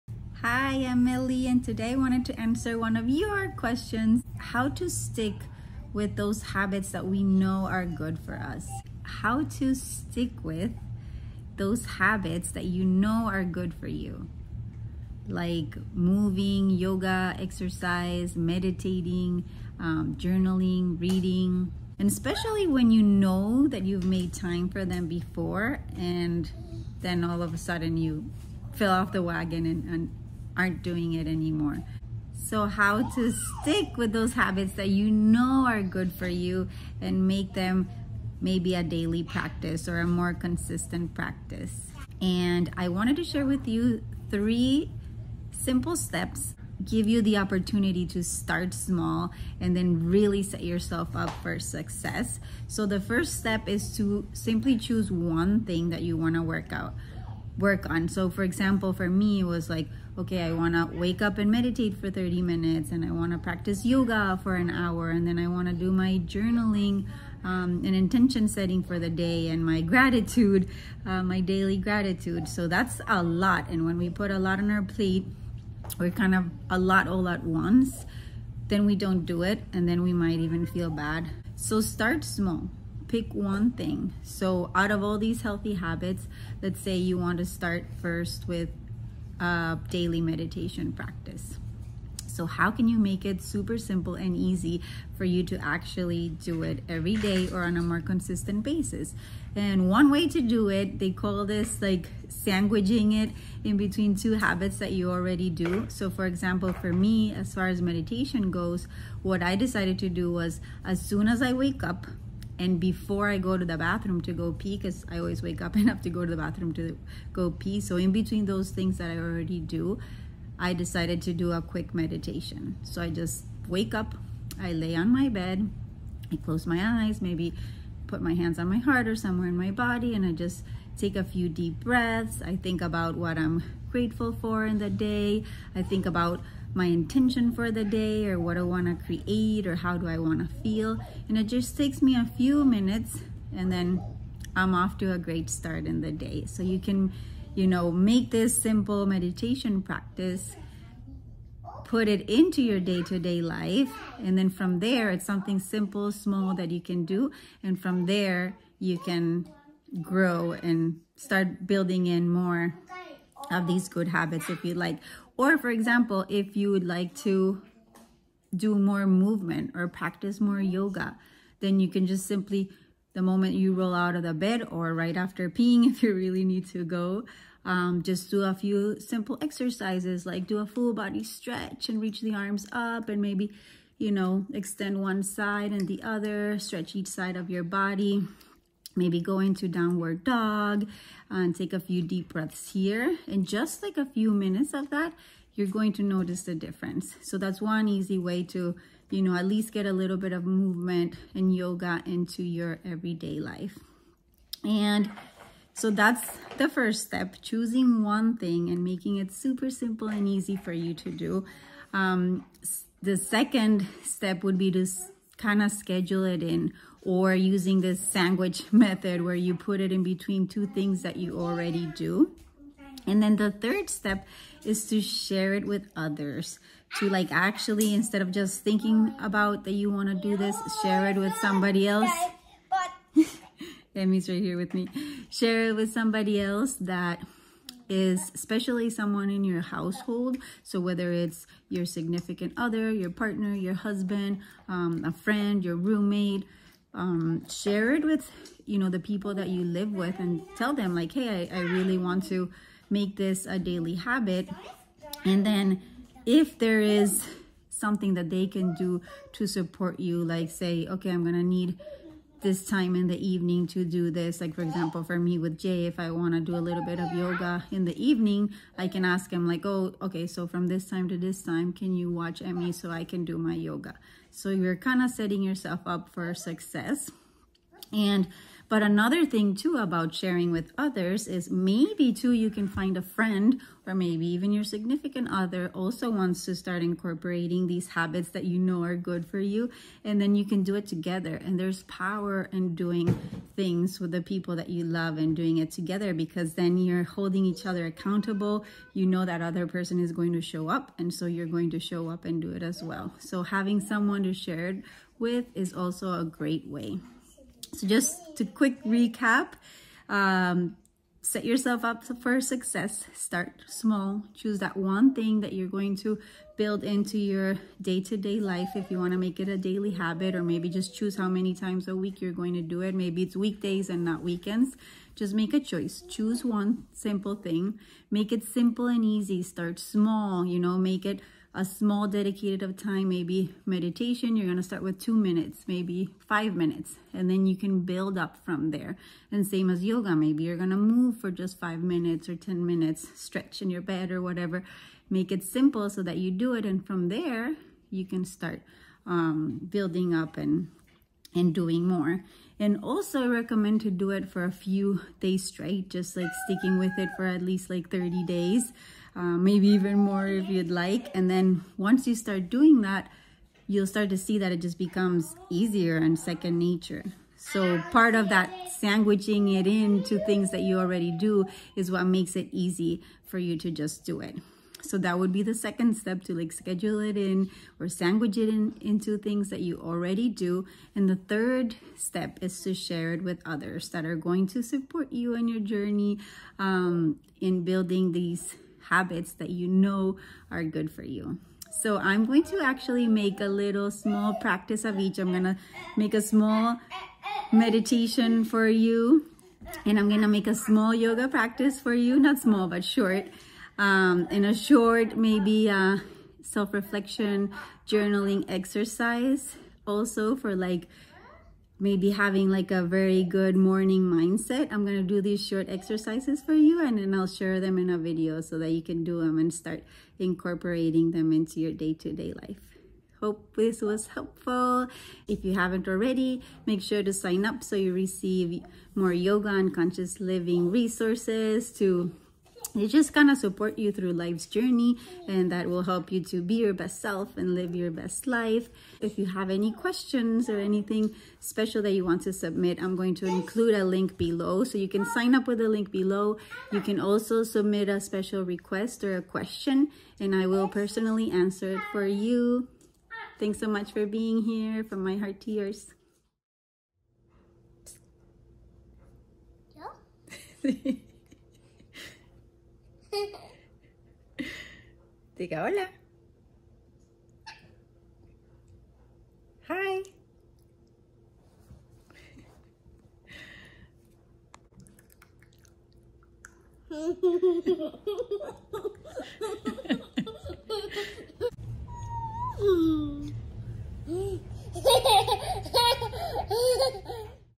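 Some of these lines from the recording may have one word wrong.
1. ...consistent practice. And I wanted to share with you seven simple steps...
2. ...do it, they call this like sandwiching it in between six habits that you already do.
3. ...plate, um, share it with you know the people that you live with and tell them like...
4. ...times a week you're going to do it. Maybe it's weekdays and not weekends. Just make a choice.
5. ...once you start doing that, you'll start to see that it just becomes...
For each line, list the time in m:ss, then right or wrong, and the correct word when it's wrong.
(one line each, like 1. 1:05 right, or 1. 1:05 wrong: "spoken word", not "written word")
1. 0:40 wrong: "three", not "seven"
2. 1:40 wrong: "two", not "six"
3. 4:05 wrong: "roommate", not "plate"
4. 5:21 right
5. 6:01 right.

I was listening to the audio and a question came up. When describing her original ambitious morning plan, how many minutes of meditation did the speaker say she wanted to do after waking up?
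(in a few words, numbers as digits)
30.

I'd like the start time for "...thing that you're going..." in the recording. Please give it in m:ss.
5:15.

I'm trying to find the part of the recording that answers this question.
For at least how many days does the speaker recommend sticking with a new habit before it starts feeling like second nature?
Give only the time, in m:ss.
5:57.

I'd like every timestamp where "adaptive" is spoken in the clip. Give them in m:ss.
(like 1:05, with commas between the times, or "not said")
not said.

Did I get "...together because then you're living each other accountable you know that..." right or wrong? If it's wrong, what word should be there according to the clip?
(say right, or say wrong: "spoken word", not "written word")
wrong: "holding", not "living".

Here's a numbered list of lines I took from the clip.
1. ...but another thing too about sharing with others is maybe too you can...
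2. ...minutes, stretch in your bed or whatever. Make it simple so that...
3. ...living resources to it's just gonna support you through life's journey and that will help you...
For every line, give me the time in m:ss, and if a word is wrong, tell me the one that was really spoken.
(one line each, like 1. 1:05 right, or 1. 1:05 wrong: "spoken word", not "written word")
1. 4:38 right
2. 5:42 right
3. 7:10 right.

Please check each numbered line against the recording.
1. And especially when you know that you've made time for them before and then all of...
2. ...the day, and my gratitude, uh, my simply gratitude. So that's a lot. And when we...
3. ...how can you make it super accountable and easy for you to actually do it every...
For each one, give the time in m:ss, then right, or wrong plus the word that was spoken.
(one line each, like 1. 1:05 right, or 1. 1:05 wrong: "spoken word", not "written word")
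1. 0:21 right
2. 1:08 wrong: "daily", not "simply"
3. 1:32 wrong: "simple", not "accountable".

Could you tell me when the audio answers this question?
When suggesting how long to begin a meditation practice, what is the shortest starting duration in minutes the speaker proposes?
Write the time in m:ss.
5:34.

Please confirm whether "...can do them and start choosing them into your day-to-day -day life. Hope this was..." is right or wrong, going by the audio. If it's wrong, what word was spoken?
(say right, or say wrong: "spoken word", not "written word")
wrong: "incorporating", not "choosing".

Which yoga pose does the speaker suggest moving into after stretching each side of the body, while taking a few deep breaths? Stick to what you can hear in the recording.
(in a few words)
downward dog.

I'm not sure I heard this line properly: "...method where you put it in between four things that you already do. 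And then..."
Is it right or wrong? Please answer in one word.
wrong.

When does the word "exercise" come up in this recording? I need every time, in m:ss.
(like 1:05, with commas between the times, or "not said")
0:17, 2:59, 6:48, 6:55.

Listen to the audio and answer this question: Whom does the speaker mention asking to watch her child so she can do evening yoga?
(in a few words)
Jay.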